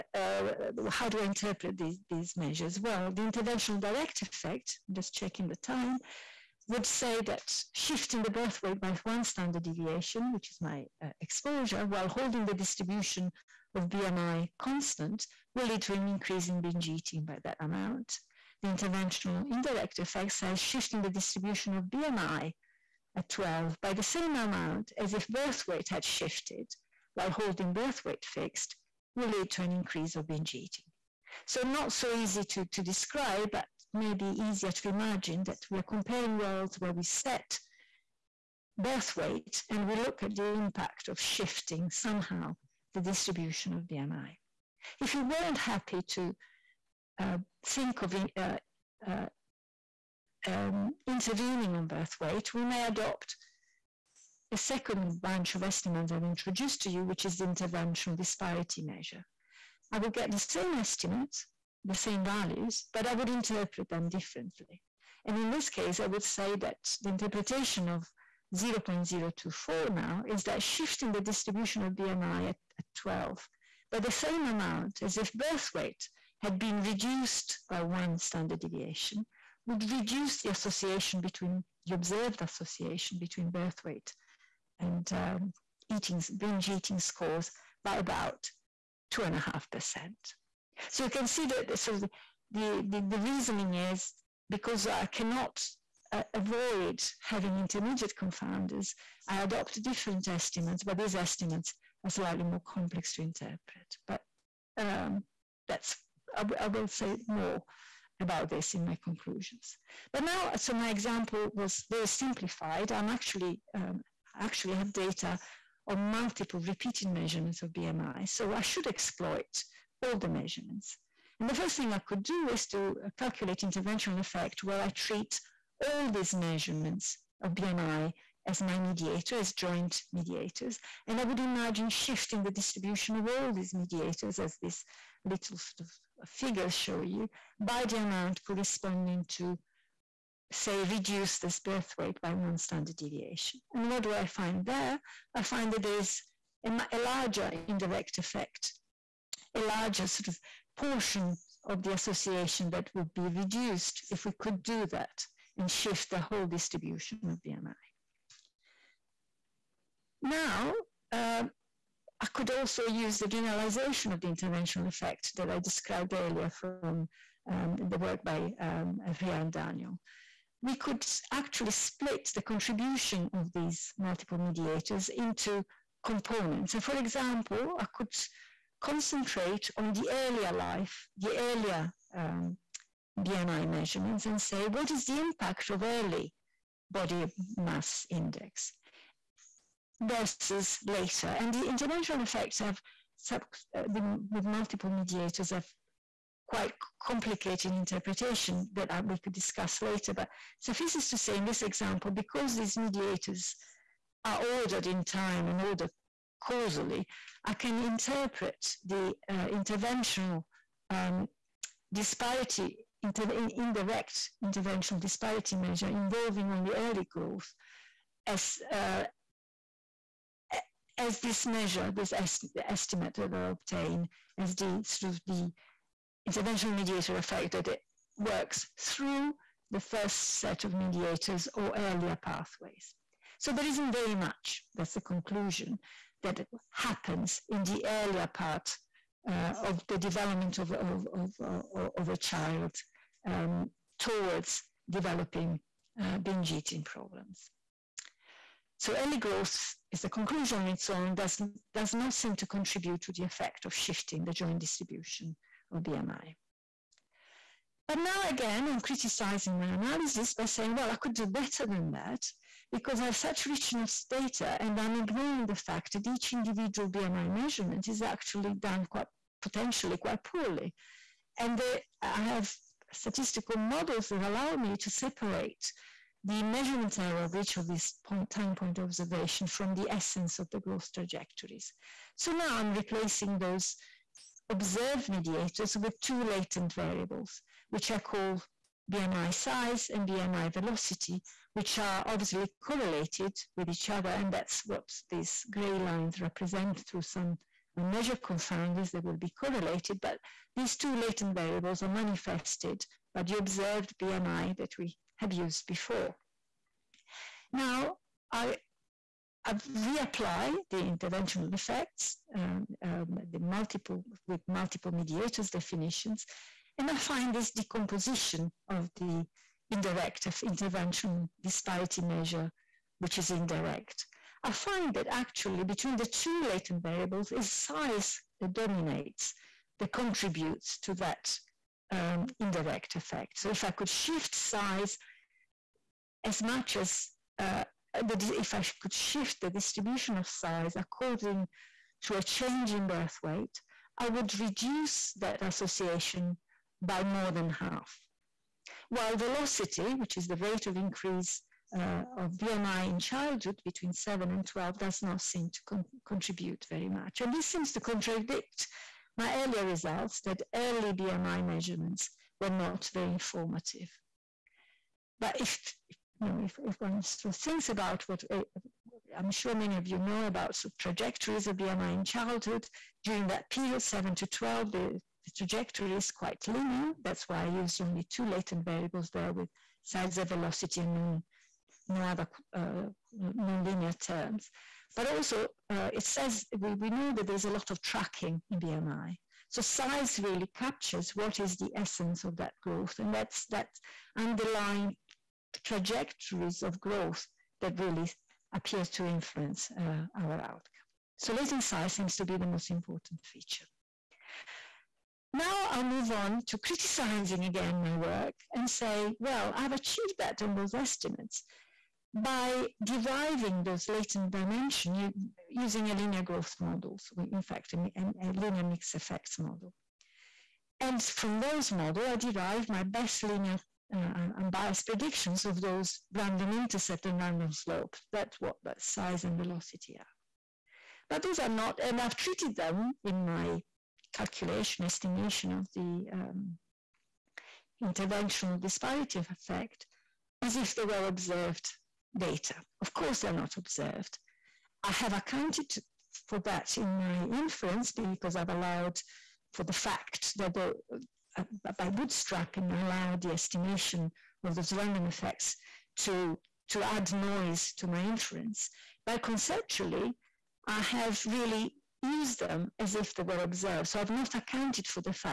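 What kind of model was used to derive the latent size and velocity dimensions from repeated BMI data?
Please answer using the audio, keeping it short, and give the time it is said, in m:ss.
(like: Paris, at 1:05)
linear mixed effects model, at 6:58.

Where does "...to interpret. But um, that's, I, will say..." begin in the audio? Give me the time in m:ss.
1:43.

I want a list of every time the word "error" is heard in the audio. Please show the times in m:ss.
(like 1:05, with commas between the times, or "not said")
4:36.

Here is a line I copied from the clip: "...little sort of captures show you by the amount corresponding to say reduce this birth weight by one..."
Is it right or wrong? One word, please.
wrong.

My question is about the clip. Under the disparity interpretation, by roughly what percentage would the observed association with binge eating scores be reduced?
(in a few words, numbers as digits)
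two and a half percent.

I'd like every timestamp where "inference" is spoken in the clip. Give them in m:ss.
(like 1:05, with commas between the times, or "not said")
7:27, 7:38.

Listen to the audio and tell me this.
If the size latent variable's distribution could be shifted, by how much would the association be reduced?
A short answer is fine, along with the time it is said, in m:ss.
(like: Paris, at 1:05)
more than half, at 5:47.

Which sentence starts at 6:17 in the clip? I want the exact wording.
That's why I used only two latent variables there with size and velocity and non, no other uh, non-linear terms.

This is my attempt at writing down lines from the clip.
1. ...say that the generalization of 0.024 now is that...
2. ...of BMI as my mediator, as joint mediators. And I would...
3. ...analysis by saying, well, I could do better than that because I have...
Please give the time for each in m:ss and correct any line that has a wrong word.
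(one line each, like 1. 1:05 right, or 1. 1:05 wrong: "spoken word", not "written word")
1. 1:06 wrong: "interpretation", not "generalization"
2. 2:07 right
3. 4:19 right.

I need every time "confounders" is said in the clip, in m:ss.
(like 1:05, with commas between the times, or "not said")
1:38, 4:58.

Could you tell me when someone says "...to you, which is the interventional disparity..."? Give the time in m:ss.
0:56.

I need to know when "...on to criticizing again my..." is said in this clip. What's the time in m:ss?
6:46.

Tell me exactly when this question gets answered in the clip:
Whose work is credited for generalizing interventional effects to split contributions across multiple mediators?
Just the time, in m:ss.
2:49.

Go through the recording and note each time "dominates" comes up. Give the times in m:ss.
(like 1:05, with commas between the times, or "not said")
5:28.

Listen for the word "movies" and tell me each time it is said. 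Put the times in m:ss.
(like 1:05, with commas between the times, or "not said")
not said.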